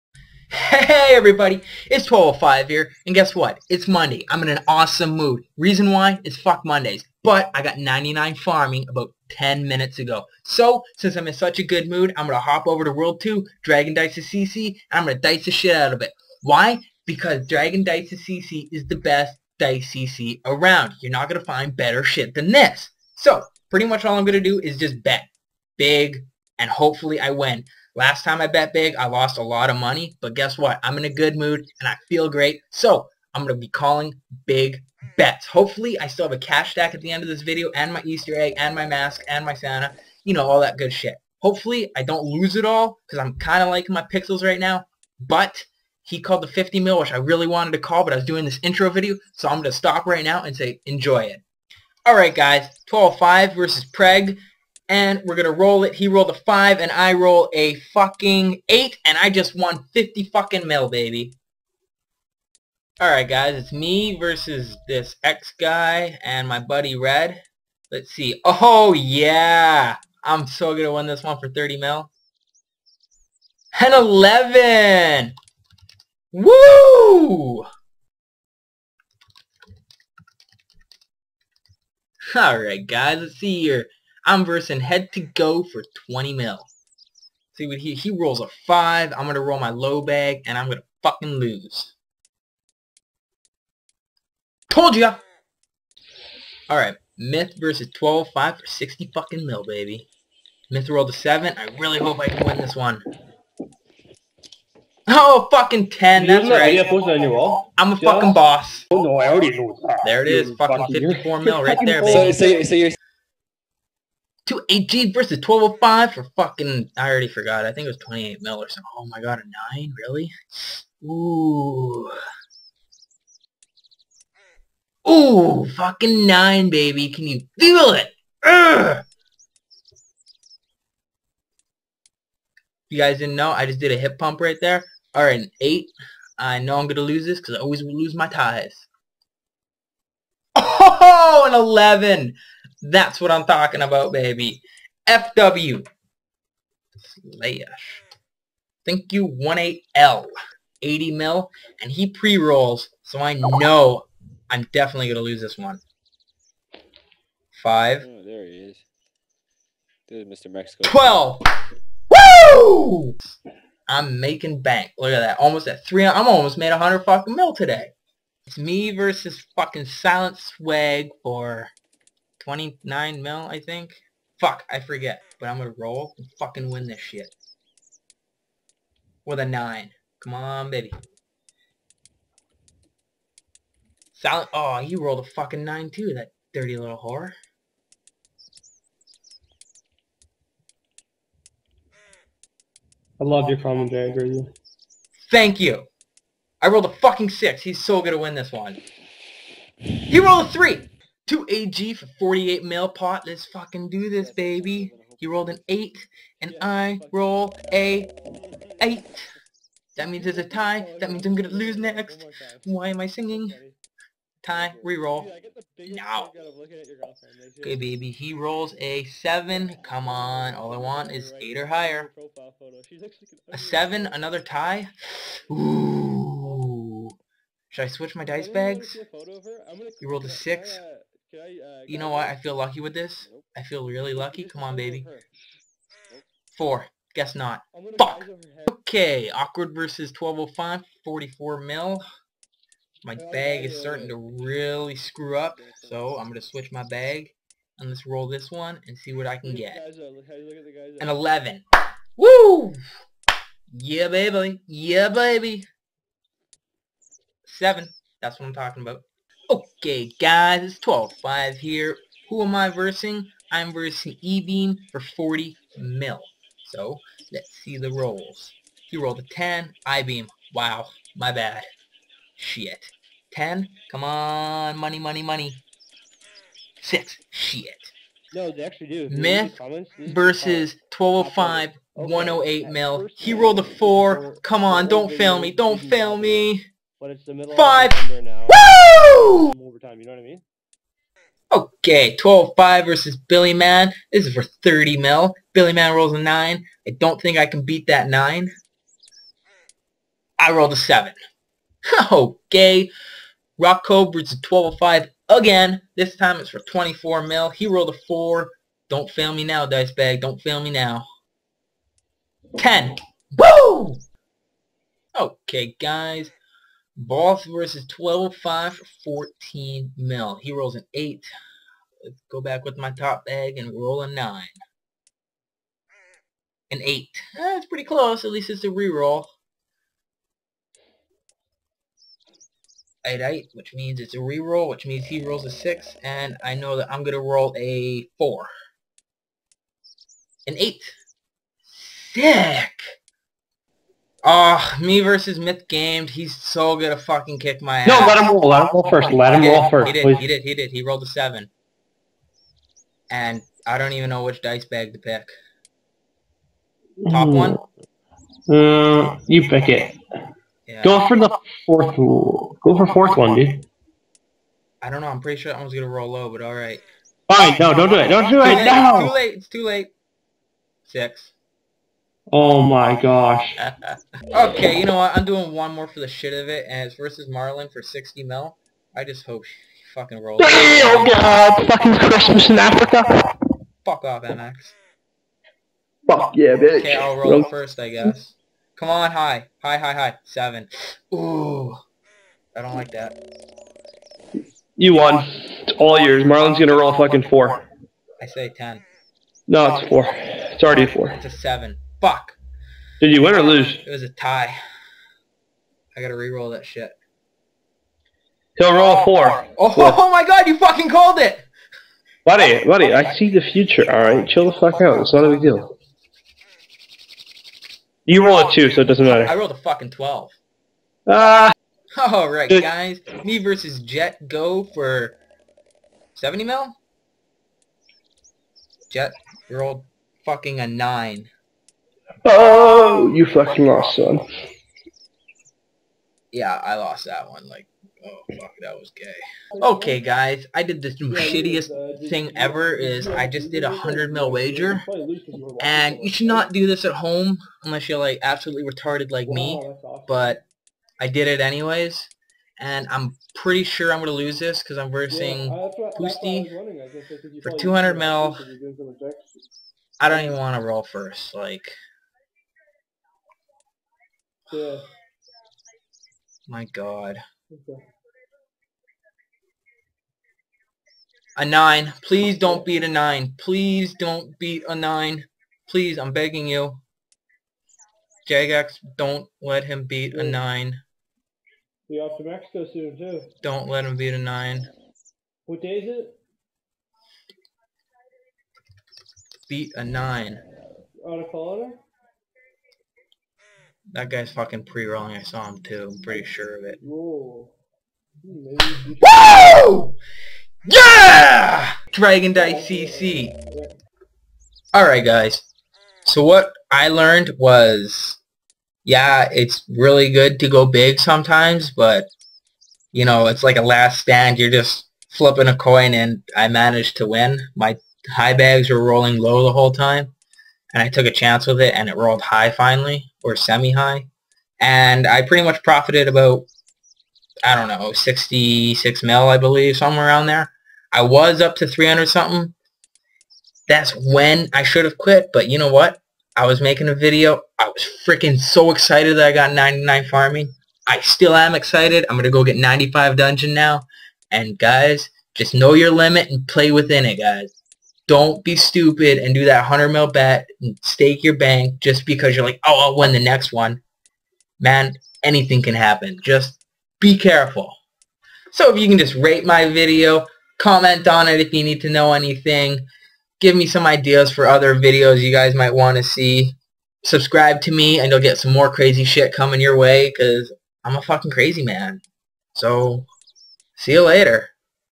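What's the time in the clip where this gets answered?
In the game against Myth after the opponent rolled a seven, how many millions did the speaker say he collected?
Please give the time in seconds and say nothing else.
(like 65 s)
110 s.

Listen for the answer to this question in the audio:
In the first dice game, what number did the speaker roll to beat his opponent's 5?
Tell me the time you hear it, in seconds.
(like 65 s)
56 s.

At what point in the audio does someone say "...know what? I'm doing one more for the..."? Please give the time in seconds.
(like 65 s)
374 s.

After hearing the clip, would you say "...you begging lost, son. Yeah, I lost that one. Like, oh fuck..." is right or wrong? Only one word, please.
wrong.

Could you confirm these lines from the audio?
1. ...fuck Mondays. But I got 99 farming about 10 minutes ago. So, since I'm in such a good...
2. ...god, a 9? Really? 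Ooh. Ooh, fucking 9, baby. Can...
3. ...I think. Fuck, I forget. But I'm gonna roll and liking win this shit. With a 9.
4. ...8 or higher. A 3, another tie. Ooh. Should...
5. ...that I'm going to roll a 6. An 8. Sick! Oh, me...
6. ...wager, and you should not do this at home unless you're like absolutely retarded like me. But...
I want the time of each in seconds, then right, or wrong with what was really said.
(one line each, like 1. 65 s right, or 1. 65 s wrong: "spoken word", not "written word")
1. 6 s right
2. 119 s right
3. 173 s wrong: "fucking", not "liking"
4. 221 s wrong: "7", not "3"
5. 336 s wrong: "4", not "6"
6. 444 s right.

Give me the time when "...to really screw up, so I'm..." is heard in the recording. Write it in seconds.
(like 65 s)
244 s.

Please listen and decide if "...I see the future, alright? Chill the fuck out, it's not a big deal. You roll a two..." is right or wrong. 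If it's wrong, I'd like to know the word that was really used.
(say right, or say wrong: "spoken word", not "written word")
right.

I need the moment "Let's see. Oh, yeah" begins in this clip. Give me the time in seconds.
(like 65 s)
67 s.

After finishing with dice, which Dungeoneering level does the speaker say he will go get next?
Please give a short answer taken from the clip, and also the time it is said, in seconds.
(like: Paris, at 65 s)
95, at 542 s.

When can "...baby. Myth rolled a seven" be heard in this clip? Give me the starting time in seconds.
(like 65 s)
99 s.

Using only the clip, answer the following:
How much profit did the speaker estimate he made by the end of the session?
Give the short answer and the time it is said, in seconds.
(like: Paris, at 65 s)
66 mil, at 527 s.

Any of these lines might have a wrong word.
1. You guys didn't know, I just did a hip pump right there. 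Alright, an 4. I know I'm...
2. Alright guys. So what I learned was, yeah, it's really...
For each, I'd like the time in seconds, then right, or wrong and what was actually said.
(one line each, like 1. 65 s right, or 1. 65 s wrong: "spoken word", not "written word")
1. 132 s wrong: "8", not "4"
2. 504 s right.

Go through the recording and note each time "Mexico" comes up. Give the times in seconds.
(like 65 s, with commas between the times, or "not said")
160 s, 482 s.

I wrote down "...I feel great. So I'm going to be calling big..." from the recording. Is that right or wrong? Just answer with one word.
right.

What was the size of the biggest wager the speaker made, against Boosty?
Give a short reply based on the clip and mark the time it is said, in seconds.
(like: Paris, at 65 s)
200 mil, at 457 s.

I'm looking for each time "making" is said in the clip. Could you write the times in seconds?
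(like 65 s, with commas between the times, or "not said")
164 s, 536 s.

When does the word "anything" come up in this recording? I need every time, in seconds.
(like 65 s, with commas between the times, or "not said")
555 s, 562 s.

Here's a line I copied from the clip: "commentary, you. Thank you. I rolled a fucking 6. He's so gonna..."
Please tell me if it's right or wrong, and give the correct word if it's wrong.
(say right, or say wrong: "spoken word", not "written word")
right.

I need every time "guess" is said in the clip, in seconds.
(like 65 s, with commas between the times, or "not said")
3 s, 30 s, 237 s, 387 s.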